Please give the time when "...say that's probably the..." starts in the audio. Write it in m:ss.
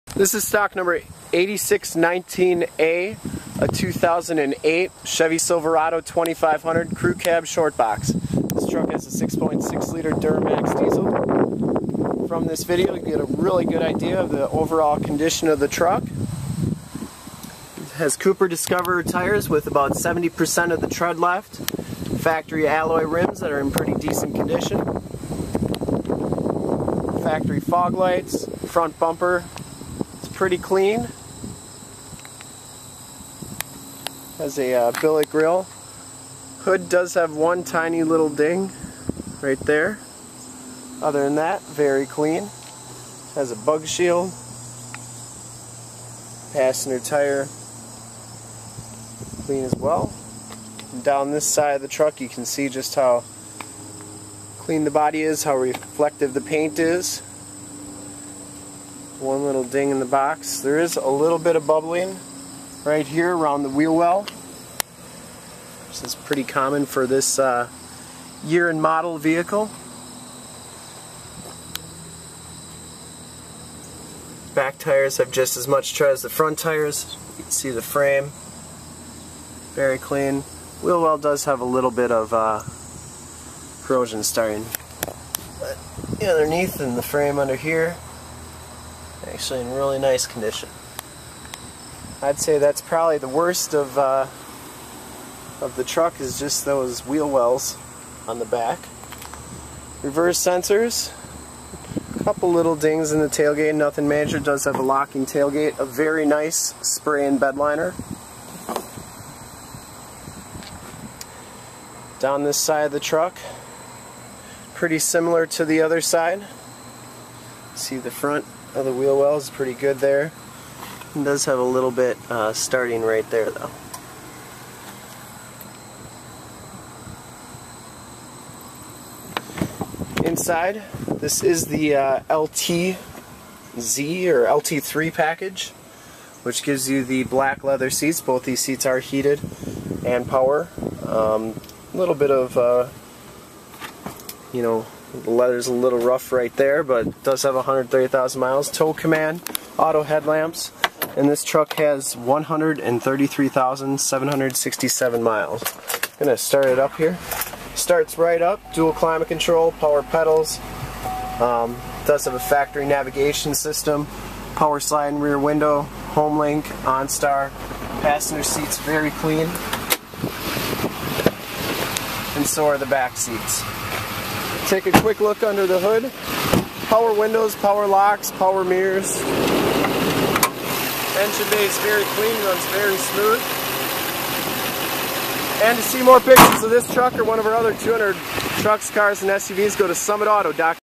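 1:32.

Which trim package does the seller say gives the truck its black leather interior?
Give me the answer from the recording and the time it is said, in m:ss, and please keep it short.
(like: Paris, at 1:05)
LTZ or LT3, at 2:12.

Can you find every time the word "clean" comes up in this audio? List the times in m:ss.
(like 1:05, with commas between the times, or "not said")
0:30, 0:42, 0:49, 0:54, 1:19, 2:49, 3:02.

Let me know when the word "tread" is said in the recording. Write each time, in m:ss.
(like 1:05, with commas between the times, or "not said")
0:20, 1:15.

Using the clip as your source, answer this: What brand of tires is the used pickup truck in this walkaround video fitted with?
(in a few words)
Cooper Discoverer.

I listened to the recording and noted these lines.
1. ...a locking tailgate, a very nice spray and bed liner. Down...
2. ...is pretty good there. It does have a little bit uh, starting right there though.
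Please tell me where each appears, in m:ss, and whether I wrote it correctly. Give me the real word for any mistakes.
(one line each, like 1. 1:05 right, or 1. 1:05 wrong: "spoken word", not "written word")
1. 1:44 right
2. 1:59 right.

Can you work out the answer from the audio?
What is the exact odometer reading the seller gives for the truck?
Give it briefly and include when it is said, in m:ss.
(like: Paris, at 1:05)
133,767 miles, at 2:32.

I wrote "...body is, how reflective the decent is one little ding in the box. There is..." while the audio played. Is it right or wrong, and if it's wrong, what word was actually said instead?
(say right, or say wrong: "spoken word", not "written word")
wrong: "paint", not "decent".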